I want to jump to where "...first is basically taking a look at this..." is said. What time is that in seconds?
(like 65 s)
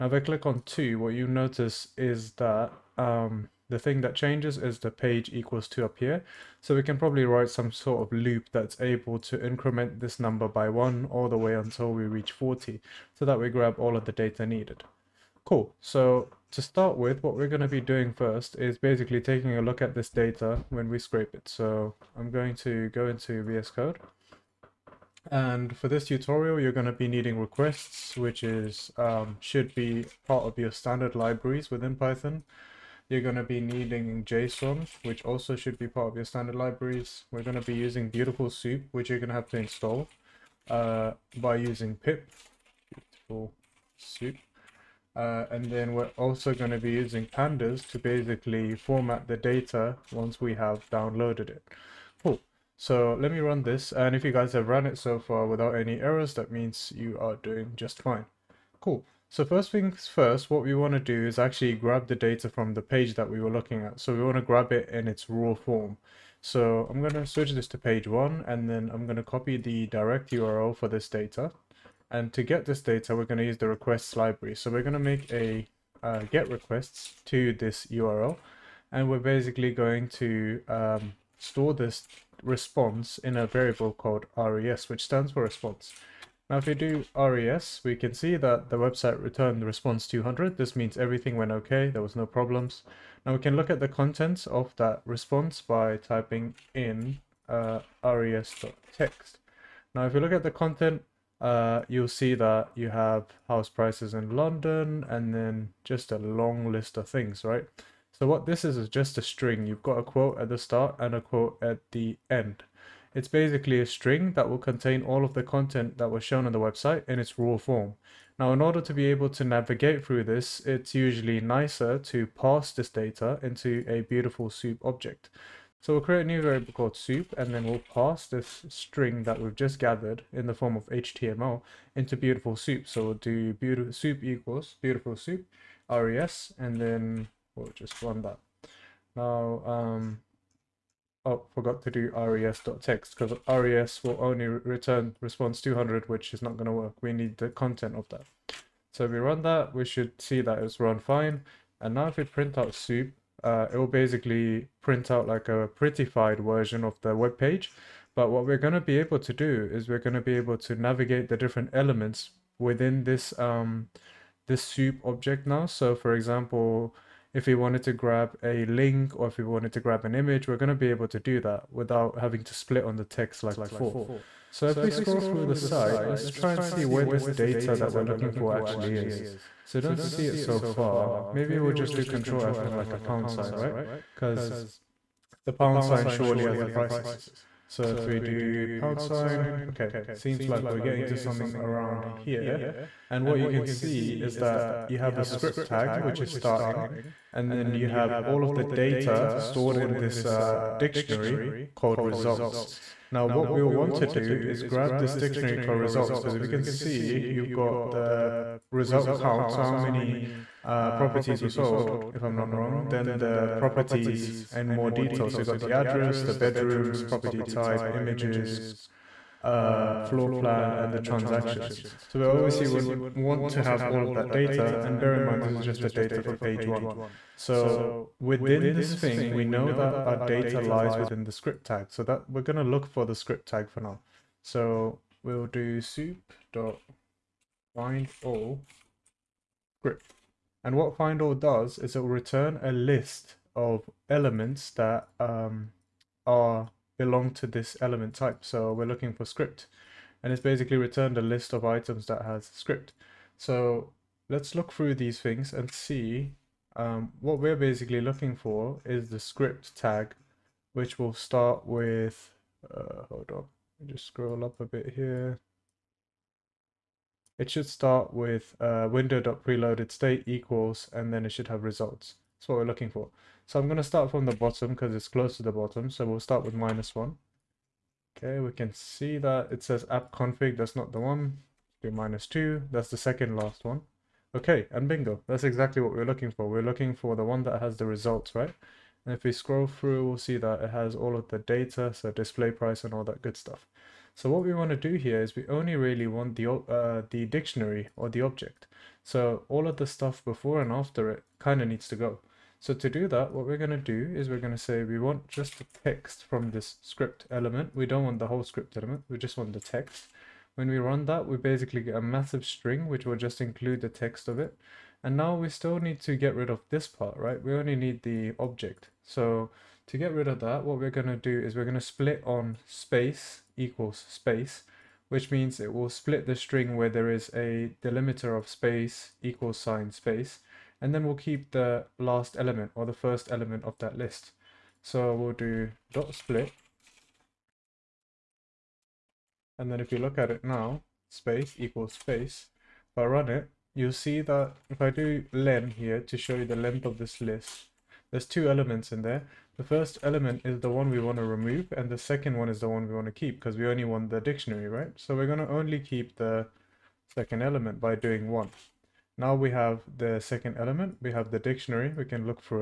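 18 s.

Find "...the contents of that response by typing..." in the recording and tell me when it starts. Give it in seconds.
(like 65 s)
93 s.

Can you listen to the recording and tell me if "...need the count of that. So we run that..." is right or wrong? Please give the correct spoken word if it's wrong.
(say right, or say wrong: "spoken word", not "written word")
wrong: "content", not "count".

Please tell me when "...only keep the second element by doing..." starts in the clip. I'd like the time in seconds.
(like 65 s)
355 s.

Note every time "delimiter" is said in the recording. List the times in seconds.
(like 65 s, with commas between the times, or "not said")
327 s.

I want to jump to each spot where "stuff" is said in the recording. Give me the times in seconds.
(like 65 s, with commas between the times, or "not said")
293 s, 299 s.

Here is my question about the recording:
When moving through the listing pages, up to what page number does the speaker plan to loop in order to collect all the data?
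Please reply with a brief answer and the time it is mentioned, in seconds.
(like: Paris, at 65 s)
40, at 12 s.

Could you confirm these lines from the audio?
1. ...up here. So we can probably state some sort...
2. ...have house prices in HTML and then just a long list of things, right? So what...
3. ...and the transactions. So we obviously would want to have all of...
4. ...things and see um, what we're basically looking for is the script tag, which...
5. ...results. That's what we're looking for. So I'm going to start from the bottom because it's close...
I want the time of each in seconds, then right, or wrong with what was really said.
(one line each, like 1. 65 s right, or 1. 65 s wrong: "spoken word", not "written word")
1. 5 s wrong: "write", not "state"
2. 102 s wrong: "London", not "HTML"
3. 220 s right
4. 255 s right
5. 271 s right.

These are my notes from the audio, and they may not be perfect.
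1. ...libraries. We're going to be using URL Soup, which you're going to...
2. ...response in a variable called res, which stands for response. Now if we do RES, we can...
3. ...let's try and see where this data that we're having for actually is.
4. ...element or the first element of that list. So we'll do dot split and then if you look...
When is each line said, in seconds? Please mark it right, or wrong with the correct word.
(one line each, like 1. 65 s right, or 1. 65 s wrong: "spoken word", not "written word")
1. 36 s wrong: "Beautiful", not "URL"
2. 82 s right
3. 176 s wrong: "looking", not "having"
4. 332 s right.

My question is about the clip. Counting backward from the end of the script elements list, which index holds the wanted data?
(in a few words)
minus two.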